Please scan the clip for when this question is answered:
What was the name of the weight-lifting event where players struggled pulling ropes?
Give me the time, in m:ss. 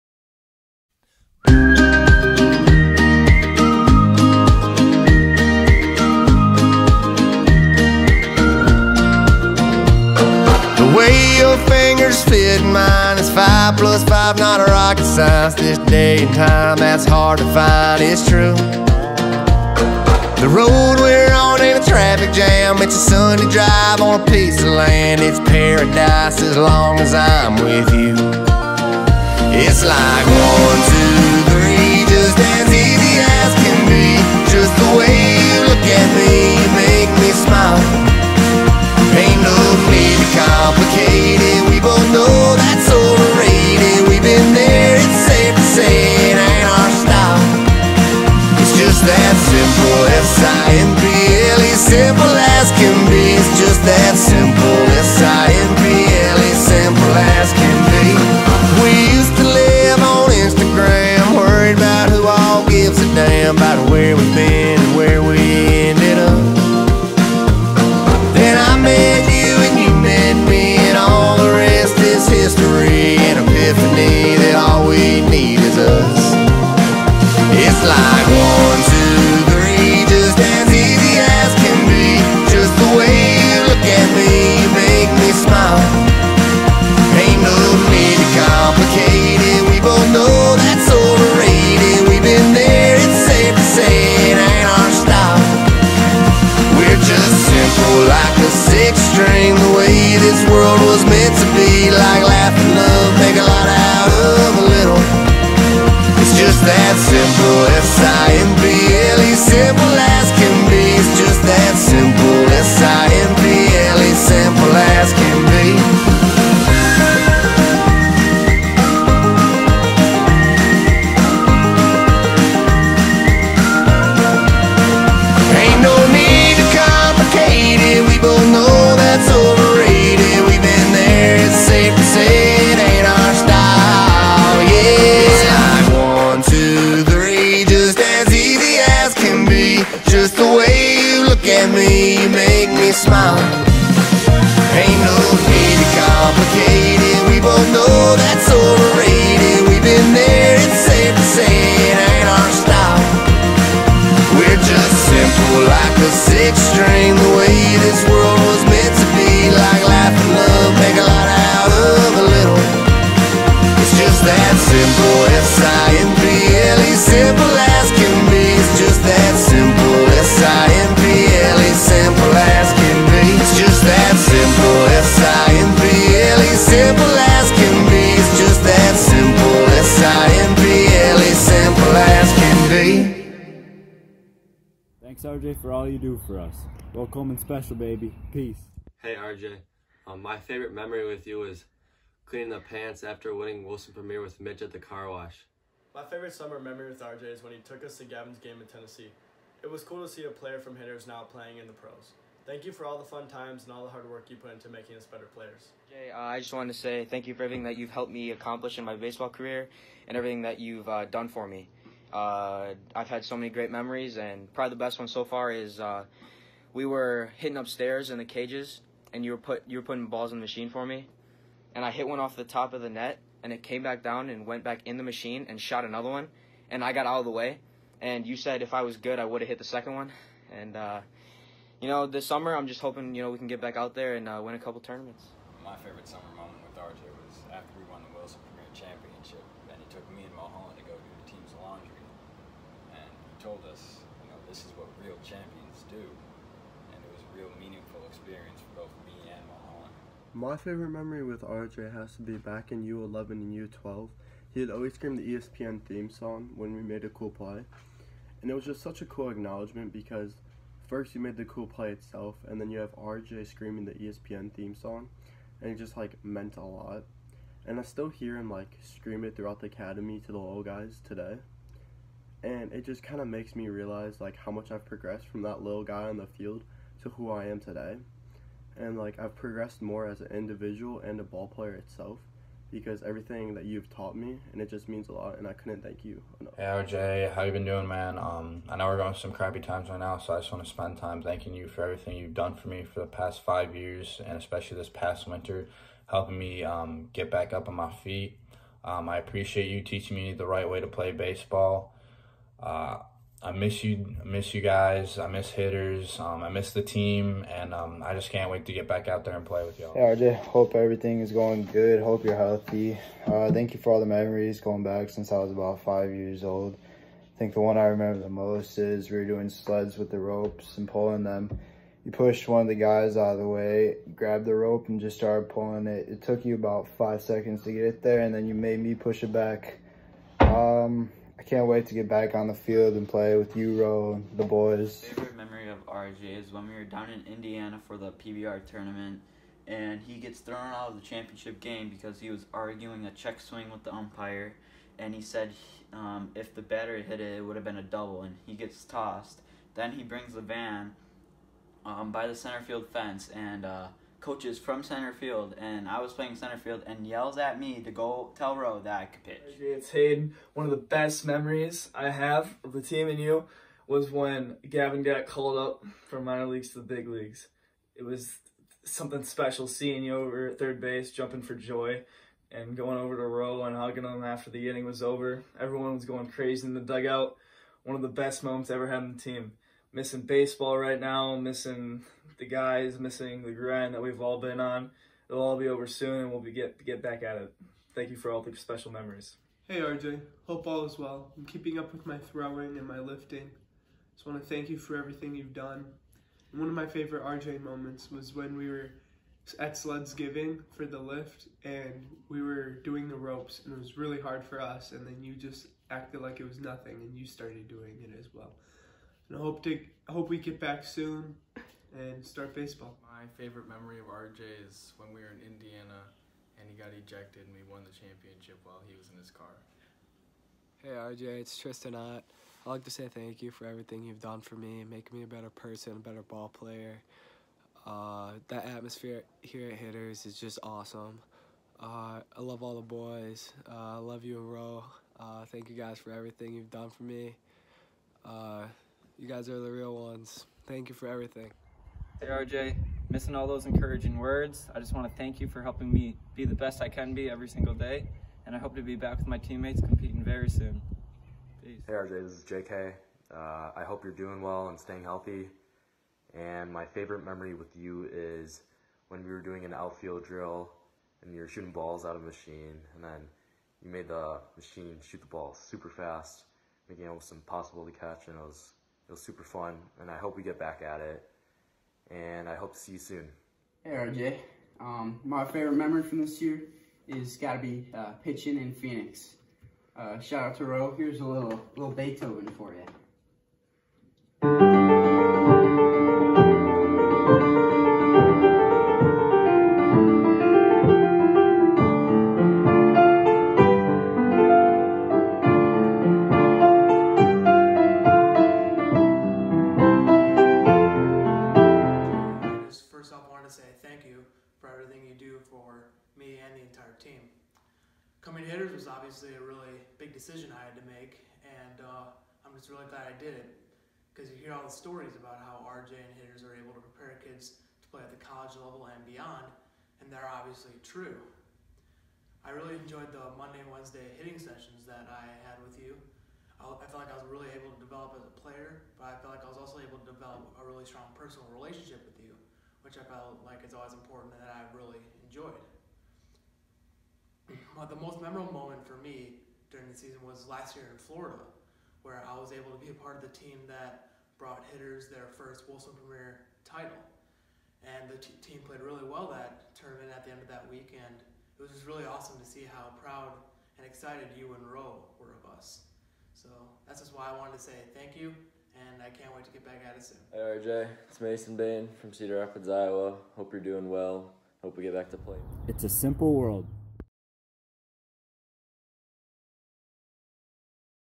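6:39.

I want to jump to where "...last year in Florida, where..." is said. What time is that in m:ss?
9:00.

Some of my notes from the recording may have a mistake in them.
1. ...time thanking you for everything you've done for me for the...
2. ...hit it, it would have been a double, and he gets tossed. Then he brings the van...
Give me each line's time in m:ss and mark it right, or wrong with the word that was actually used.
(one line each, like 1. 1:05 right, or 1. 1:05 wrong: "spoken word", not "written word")
1. 4:50 right
2. 5:47 right.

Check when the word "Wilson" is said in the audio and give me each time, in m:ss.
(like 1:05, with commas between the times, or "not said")
3:13, 3:58, 9:05.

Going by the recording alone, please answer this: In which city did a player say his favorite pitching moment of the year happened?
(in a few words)
Phoenix.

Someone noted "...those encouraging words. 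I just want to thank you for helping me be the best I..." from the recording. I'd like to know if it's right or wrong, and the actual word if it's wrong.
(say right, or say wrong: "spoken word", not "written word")
right.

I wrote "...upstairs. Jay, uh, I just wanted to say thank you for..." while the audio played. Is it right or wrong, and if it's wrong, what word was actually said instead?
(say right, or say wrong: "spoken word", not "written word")
wrong: "players", not "upstairs".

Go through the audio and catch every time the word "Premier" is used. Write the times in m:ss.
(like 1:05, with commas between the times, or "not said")
3:13, 3:58, 9:06.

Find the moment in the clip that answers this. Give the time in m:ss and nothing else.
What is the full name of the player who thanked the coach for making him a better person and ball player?
7:01.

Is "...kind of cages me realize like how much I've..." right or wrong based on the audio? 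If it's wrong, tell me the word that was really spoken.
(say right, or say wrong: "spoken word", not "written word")
wrong: "makes", not "cages".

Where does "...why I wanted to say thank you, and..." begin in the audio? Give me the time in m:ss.
9:17.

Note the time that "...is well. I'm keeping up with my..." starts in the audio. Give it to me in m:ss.
6:30.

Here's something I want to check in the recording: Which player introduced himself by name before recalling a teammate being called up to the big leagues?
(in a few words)
Hayden.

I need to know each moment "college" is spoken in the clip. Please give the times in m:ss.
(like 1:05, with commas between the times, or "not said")
8:38.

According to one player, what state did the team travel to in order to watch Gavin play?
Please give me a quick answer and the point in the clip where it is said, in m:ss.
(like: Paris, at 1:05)
Tennessee, at 3:18.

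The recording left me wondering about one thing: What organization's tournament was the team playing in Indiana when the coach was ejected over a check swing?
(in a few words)
PBR.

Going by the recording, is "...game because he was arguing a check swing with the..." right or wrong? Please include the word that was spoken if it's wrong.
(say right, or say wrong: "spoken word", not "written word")
right.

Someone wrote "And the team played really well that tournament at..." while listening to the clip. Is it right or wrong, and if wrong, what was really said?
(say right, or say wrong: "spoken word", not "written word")
right.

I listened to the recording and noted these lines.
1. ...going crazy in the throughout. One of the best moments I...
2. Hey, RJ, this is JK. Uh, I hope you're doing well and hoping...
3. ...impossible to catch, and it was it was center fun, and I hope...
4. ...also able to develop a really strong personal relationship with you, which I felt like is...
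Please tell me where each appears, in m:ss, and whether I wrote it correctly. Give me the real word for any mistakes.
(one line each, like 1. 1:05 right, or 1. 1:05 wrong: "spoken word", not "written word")
1. 6:16 wrong: "dugout", not "throughout"
2. 7:31 wrong: "staying", not "hoping"
3. 7:47 wrong: "super", not "center"
4. 8:49 right.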